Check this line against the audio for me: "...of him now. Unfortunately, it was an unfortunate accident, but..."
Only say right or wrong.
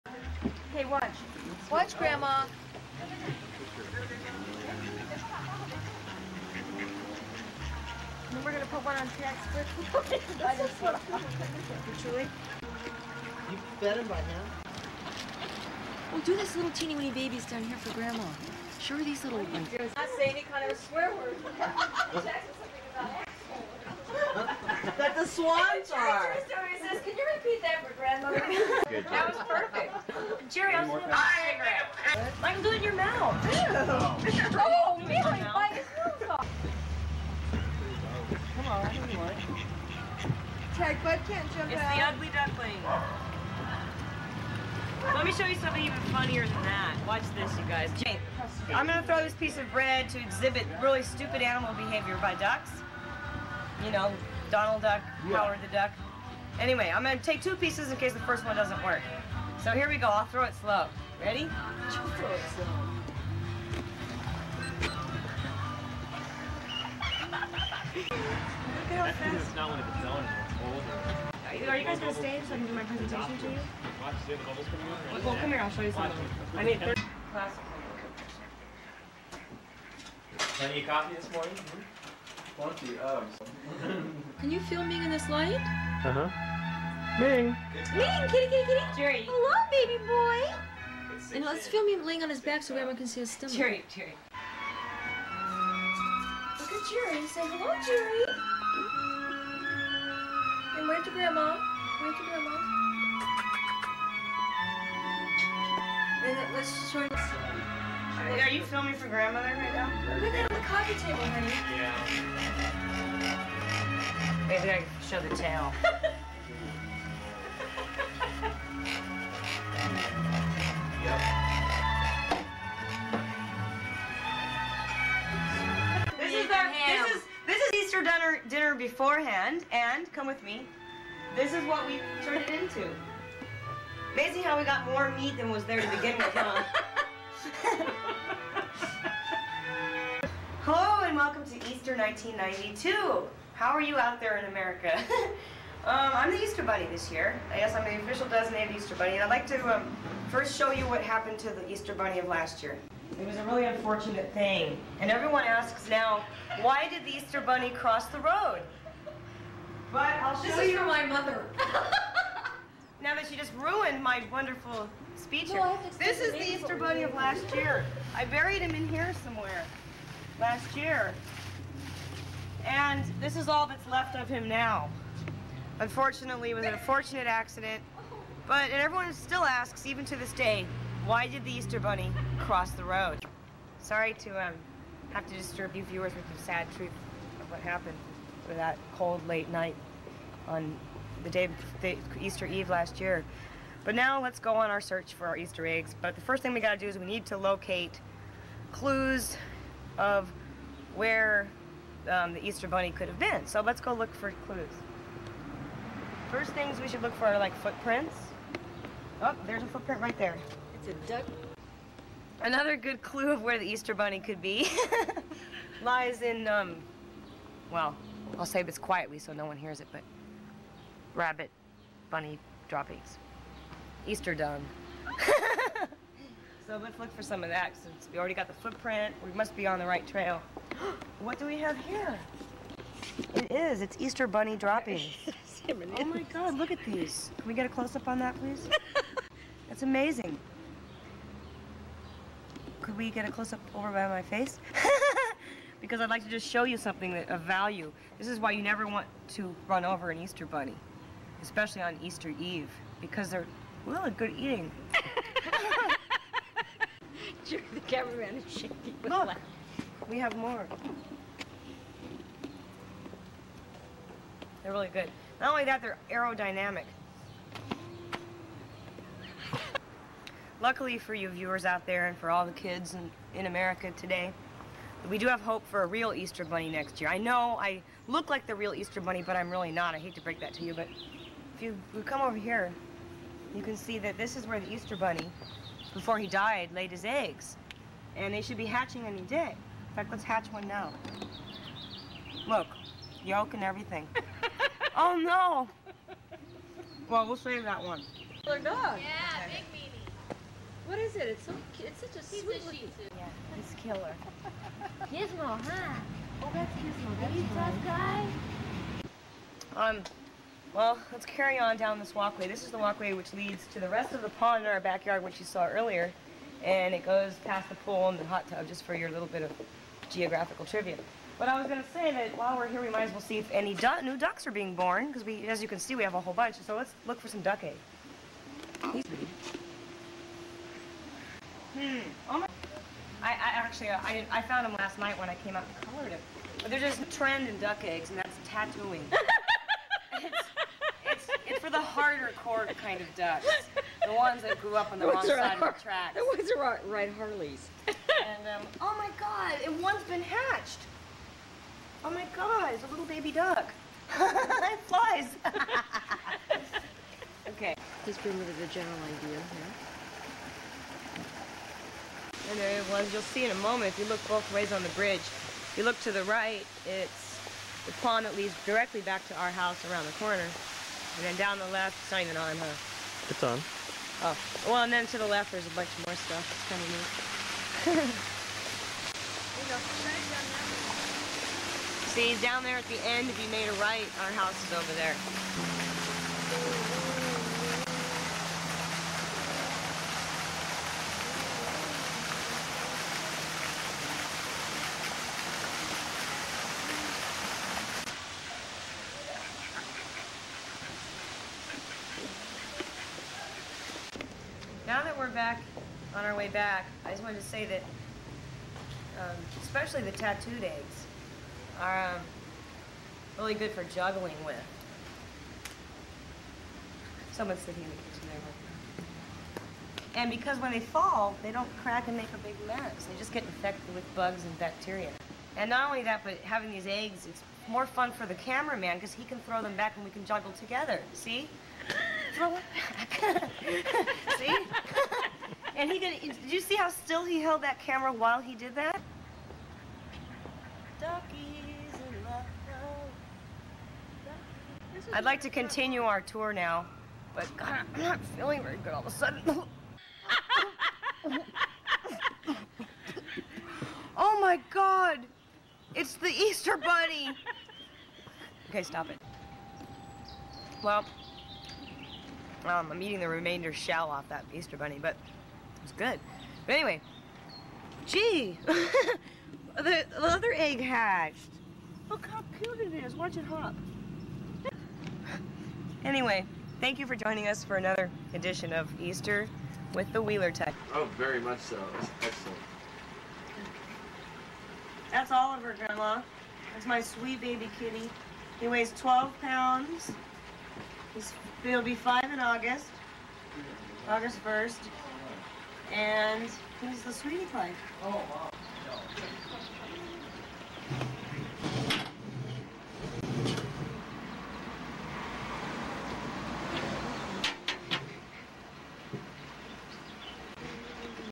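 right.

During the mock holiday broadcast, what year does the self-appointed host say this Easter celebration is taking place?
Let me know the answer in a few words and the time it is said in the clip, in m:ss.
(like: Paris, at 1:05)
1992, at 2:21.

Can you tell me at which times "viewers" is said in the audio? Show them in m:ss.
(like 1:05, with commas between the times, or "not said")
3:05, 4:31.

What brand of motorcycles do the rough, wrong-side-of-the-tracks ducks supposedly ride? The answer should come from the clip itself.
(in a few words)
Harleys.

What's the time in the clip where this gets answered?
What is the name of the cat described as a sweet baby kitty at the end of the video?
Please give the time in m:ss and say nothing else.
8:05.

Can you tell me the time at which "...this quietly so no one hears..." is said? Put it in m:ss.
3:38.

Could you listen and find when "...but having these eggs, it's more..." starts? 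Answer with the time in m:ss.
7:06.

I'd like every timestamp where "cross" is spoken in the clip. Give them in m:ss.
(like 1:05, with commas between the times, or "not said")
2:37, 3:02.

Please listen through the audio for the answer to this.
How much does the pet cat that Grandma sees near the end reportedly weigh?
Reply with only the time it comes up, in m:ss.
8:08.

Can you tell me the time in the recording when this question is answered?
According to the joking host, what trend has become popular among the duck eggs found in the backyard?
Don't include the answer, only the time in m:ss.
5:38.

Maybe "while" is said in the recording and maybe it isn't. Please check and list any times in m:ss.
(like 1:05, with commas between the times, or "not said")
5:22, 7:18.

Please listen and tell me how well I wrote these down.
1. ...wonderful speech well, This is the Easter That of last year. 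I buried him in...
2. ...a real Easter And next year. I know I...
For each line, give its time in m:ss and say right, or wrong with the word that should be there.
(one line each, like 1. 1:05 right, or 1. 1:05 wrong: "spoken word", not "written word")
1. 2:44 wrong: "Bunny", not "That"
2. 4:35 wrong: "Bunny", not "And".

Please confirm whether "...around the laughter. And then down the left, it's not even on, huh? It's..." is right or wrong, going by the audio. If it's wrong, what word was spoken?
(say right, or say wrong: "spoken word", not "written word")
wrong: "corner", not "laughter".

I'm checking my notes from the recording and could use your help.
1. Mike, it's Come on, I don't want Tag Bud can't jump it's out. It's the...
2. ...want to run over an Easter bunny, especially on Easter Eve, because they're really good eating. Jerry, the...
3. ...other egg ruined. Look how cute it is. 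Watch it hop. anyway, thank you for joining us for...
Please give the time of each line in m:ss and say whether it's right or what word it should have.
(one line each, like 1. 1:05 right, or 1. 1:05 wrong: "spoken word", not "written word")
1. 0:35 right
2. 4:08 right
3. 7:50 wrong: "hatched", not "ruined".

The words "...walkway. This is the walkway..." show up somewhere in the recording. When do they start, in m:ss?
5:12.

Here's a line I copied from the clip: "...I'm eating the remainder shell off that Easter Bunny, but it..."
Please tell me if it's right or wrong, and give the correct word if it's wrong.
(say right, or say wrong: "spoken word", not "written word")
right.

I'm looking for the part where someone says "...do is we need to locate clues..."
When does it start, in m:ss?
3:16.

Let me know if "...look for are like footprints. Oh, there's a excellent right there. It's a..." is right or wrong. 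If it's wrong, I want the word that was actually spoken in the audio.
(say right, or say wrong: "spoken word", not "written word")
wrong: "footprint", not "excellent".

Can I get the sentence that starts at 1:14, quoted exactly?
Watch, see the bubbles coming Well, well, come here, I'll show you something.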